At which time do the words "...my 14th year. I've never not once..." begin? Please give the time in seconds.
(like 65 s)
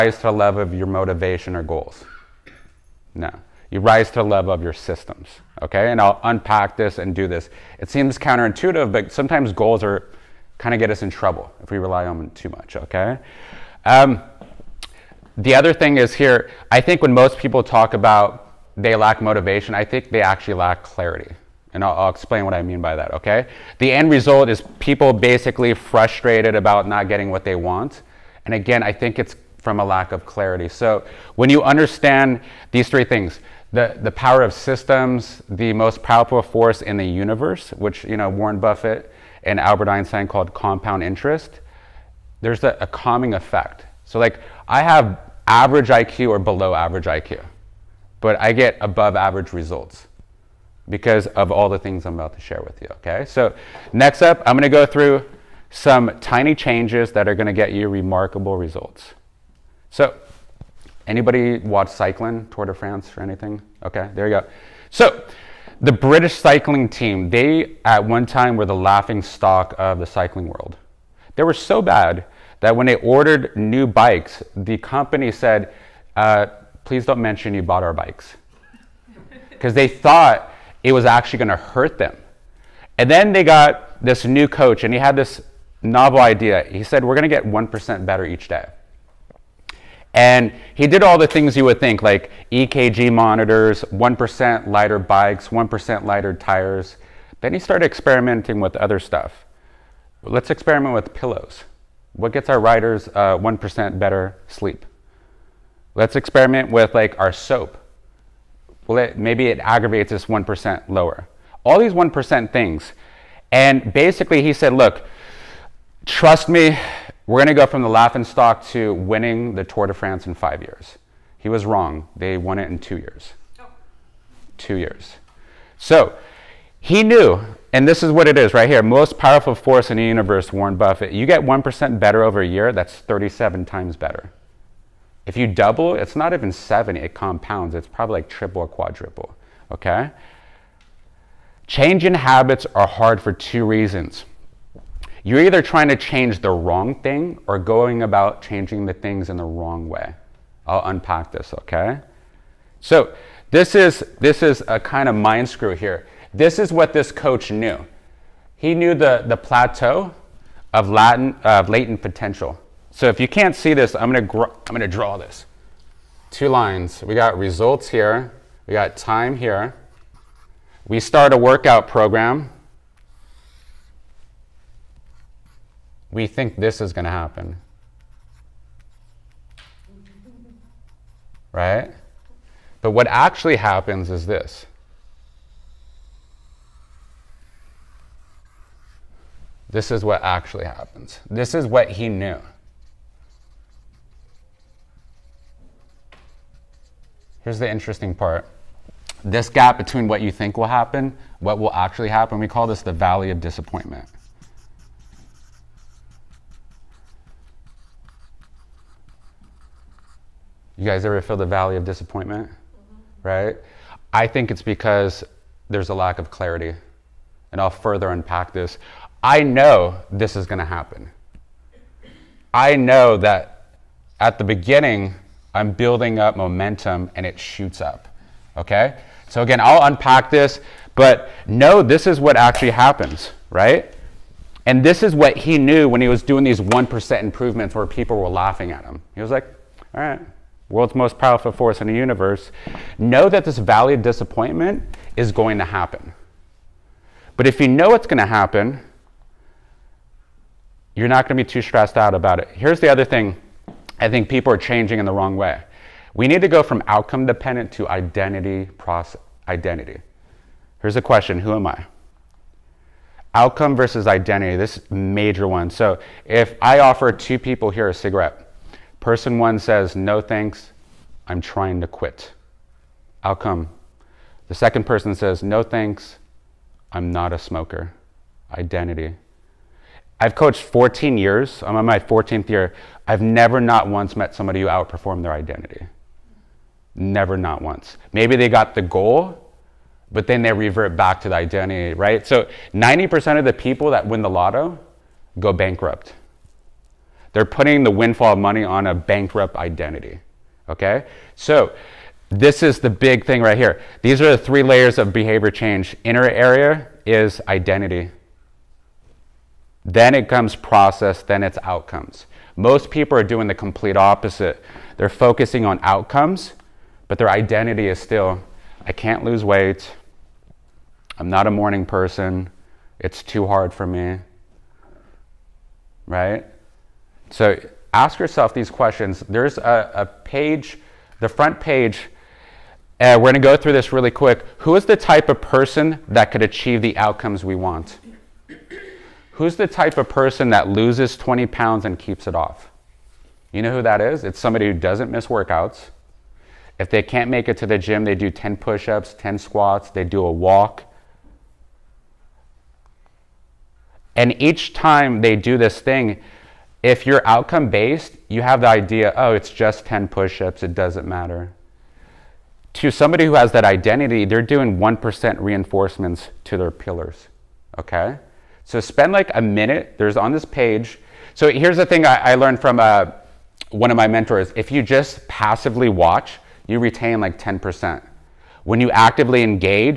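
281 s.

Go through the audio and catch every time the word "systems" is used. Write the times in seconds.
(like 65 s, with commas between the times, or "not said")
4 s, 34 s.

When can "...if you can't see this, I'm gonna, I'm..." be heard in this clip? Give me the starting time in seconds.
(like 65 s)
163 s.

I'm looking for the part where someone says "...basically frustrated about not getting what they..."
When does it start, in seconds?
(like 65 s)
25 s.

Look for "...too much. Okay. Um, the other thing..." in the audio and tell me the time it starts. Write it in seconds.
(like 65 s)
12 s.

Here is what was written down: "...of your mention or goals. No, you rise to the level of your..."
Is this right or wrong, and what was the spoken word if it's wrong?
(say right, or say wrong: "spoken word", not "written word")
wrong: "motivation", not "mention".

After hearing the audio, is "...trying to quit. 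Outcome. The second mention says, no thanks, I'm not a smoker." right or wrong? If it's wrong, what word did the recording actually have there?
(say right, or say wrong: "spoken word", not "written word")
wrong: "person", not "mention".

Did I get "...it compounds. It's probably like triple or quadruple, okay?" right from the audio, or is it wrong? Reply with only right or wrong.
right.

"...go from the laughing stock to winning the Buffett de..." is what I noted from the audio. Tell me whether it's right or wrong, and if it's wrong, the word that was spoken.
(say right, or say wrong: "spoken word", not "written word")
wrong: "Tour", not "Buffett".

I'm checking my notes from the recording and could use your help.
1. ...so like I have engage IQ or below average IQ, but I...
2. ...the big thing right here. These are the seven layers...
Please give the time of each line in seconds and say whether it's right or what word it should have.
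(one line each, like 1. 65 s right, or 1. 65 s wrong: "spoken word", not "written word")
1. 44 s wrong: "average", not "engage"
2. 302 s wrong: "three", not "seven".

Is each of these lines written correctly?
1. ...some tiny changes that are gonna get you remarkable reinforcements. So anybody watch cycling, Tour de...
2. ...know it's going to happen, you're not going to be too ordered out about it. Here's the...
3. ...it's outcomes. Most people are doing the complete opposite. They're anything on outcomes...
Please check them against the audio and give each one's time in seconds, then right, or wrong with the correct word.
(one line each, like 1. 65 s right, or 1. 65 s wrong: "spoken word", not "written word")
1. 55 s wrong: "results", not "reinforcements"
2. 247 s wrong: "stressed", not "ordered"
3. 311 s wrong: "focusing", not "anything".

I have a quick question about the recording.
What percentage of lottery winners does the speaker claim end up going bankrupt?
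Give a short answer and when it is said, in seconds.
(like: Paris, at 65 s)
90%, at 292 s.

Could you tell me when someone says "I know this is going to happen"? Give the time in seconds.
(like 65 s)
219 s.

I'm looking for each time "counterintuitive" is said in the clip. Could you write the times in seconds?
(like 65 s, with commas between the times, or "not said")
8 s.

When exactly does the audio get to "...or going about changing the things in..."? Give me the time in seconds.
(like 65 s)
147 s.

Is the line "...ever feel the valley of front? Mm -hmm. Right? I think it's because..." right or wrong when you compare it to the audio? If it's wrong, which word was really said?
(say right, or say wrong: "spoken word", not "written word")
wrong: "disappointment", not "front".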